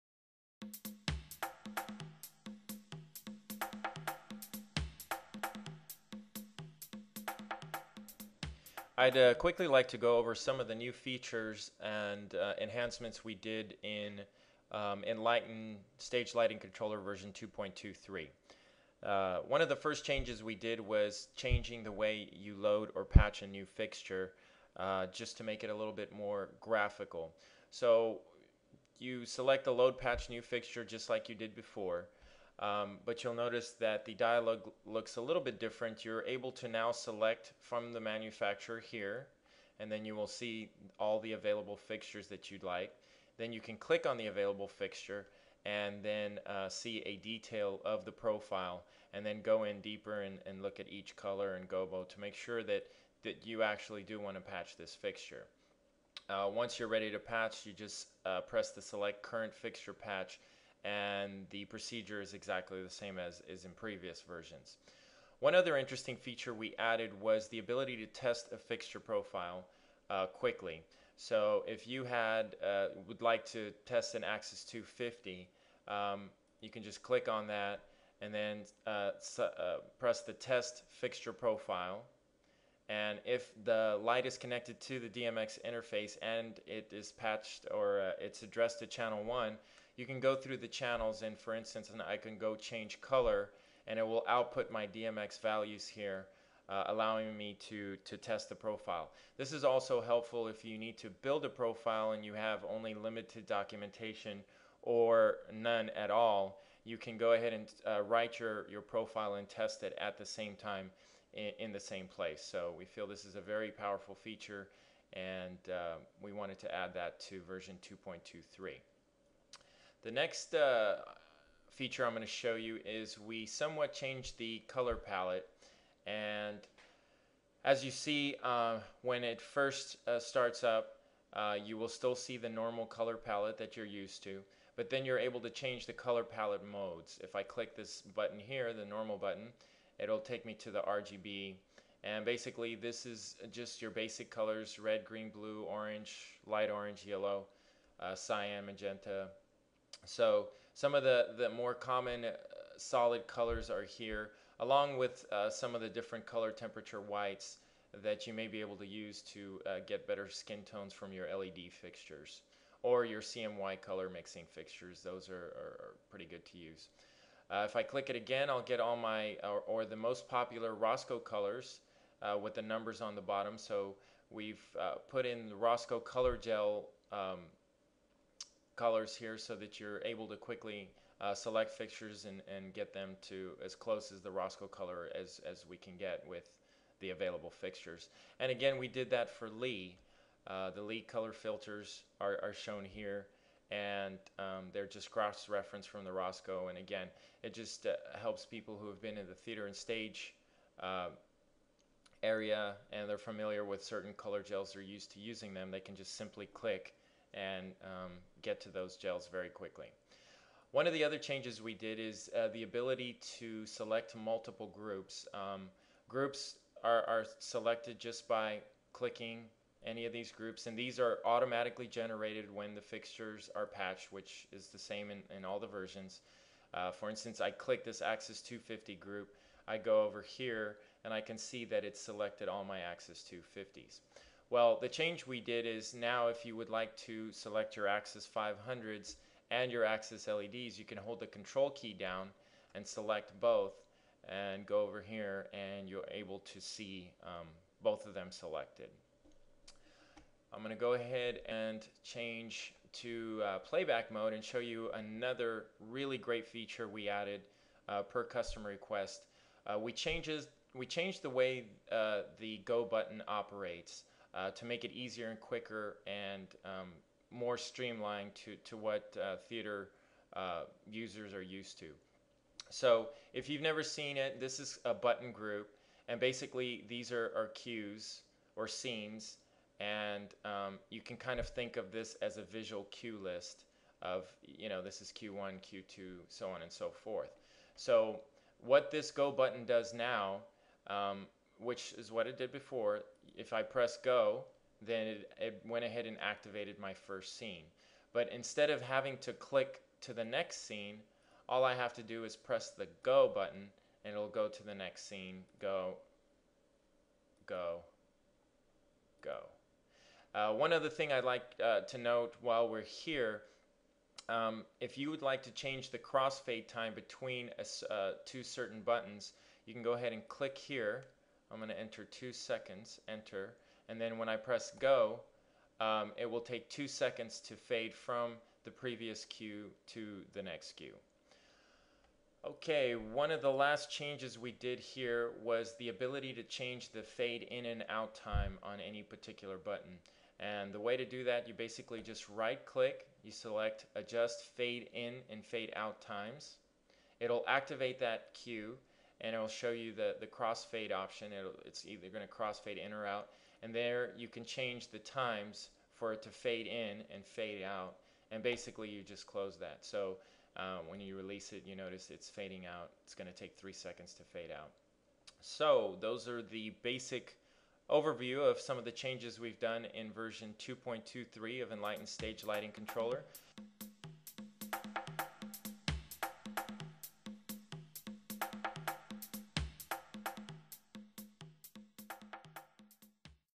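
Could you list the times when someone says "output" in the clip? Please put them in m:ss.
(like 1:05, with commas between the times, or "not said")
1:34.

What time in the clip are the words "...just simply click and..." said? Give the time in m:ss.
3:25.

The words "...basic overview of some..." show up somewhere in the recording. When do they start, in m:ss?
6:06.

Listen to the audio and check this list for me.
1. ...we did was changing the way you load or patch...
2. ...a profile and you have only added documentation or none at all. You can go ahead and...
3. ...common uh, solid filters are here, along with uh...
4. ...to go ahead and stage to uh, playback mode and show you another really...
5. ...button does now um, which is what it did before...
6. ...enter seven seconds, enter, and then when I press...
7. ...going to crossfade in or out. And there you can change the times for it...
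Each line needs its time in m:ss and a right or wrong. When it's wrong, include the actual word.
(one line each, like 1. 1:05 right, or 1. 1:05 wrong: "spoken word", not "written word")
1. 0:20 right
2. 1:41 wrong: "limited", not "added"
3. 2:31 wrong: "colors", not "filters"
4. 4:10 wrong: "change", not "stage"
5. 4:49 right
6. 5:21 wrong: "two", not "seven"
7. 5:52 right.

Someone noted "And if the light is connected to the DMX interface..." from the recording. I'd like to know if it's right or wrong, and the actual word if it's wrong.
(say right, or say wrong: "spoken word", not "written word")
right.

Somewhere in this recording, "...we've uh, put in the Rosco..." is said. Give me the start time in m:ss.
2:54.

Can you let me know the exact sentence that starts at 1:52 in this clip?
So we feel this is a very powerful feature and uh, we wanted to add that to version 2.23.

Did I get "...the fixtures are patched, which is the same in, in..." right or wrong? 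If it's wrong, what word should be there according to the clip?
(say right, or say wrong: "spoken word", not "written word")
right.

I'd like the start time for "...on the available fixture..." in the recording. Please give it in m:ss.
0:44.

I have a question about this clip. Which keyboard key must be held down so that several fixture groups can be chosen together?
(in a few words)
Control.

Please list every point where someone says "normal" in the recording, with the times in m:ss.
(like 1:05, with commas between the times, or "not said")
2:12, 2:18.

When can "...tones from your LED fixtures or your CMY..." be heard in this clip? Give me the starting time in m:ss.
2:40.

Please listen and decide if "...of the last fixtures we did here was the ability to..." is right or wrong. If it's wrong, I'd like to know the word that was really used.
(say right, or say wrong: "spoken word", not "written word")
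wrong: "changes", not "fixtures".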